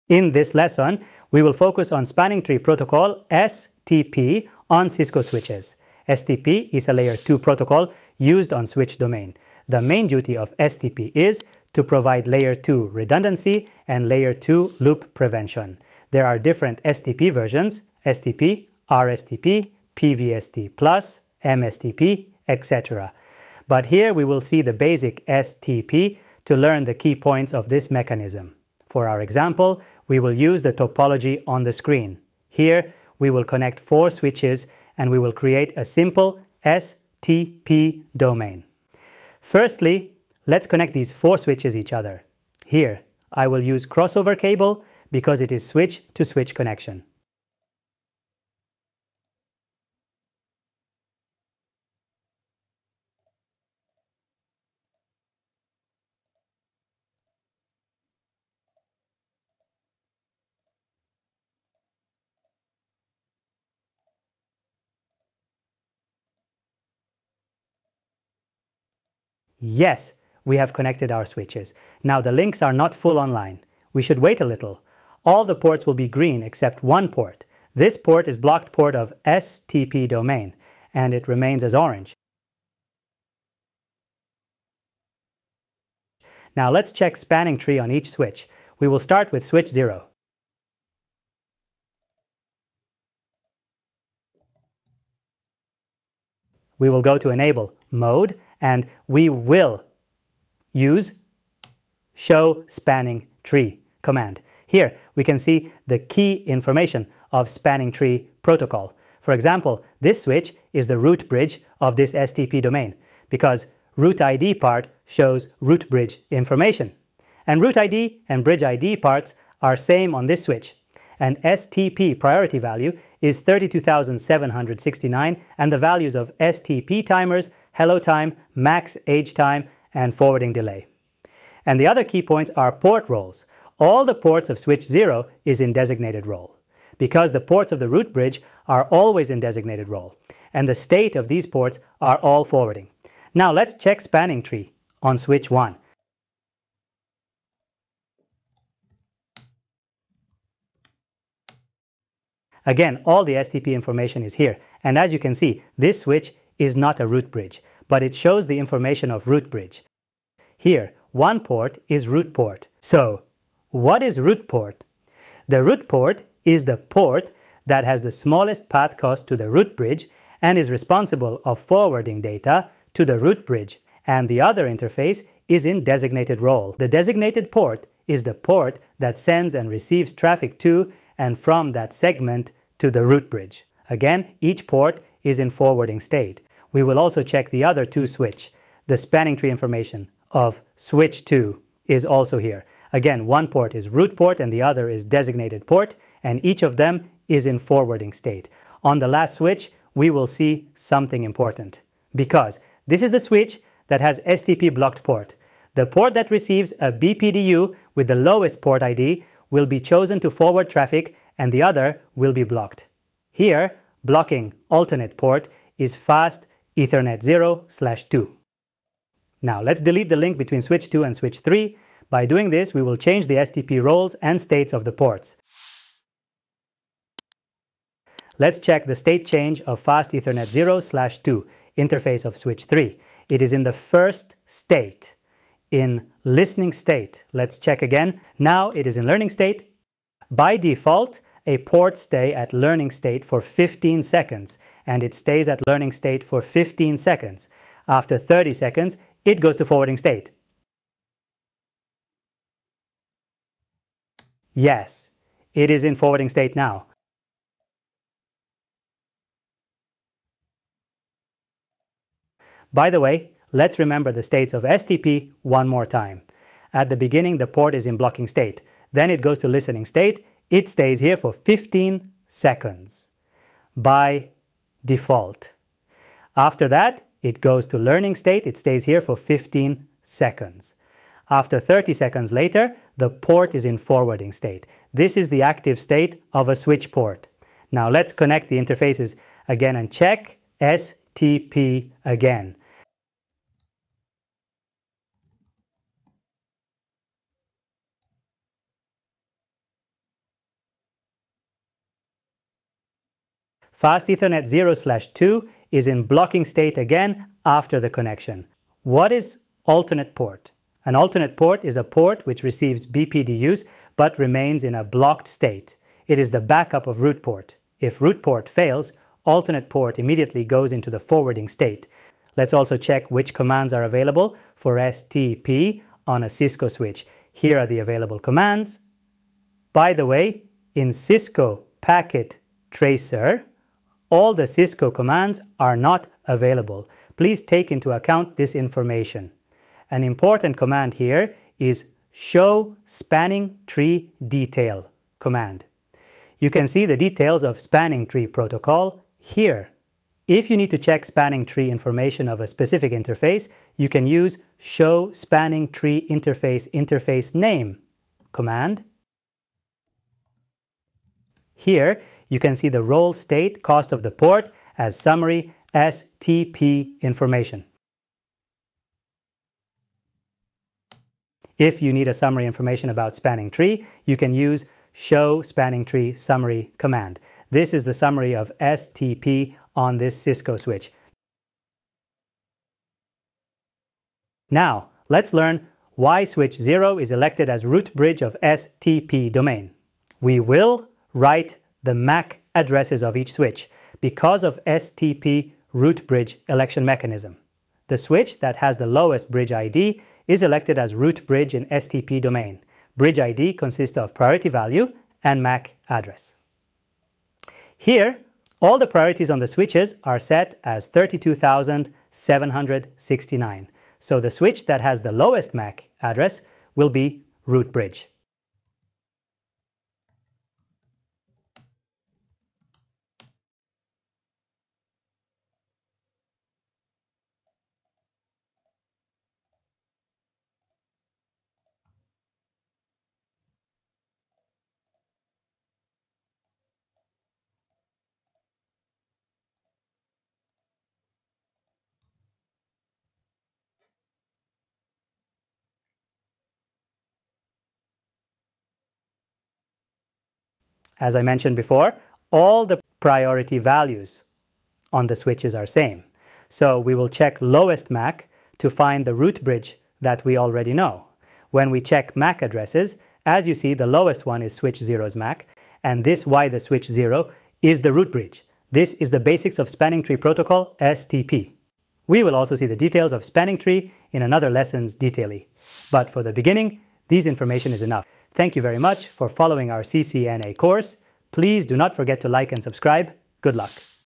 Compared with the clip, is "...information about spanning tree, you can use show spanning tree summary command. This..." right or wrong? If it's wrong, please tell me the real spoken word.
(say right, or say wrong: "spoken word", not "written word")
right.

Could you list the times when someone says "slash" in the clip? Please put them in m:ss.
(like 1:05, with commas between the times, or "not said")
3:37, 3:50, 5:04.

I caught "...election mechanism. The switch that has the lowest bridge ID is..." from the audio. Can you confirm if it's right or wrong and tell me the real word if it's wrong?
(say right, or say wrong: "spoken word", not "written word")
right.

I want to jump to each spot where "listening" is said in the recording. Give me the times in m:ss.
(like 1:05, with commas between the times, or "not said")
3:56, 4:29.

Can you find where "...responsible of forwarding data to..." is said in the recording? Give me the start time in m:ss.
2:50.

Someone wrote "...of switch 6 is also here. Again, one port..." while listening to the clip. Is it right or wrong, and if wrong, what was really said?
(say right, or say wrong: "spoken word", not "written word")
wrong: "2", not "6".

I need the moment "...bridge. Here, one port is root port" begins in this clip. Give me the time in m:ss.
2:39.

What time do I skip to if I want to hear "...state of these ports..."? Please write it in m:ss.
2:20.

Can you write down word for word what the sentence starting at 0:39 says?
Firstly, let's connect these four switches each other.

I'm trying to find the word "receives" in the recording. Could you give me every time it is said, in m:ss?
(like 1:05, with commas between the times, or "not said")
2:59, 3:26, 5:12.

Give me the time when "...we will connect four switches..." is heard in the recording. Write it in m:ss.
0:33.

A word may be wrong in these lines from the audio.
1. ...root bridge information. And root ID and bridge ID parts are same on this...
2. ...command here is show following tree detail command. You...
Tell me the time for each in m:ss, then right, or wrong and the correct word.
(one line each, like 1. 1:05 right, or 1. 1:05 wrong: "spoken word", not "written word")
1. 1:55 right
2. 5:40 wrong: "spanning", not "following".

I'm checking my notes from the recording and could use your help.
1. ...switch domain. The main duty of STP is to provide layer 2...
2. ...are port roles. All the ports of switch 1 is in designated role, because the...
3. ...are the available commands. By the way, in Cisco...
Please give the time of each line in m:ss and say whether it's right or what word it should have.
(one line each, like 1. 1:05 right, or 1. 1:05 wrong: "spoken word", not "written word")
1. 0:08 right
2. 2:12 wrong: "0", not "1"
3. 5:27 right.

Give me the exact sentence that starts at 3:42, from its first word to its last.
By doing this, we will change the STP roles and states of the ports.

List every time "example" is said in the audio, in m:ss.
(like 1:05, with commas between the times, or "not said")
0:29, 1:49.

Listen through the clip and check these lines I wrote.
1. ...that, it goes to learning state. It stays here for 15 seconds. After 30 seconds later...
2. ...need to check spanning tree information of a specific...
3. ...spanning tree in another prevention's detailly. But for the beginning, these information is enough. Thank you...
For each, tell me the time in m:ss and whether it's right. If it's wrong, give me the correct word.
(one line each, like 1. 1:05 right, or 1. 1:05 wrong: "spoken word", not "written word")
1. 4:36 right
2. 5:50 right
3. 7:53 wrong: "lesson", not "prevention".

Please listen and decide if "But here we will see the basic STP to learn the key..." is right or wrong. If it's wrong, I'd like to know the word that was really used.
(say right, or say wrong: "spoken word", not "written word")
right.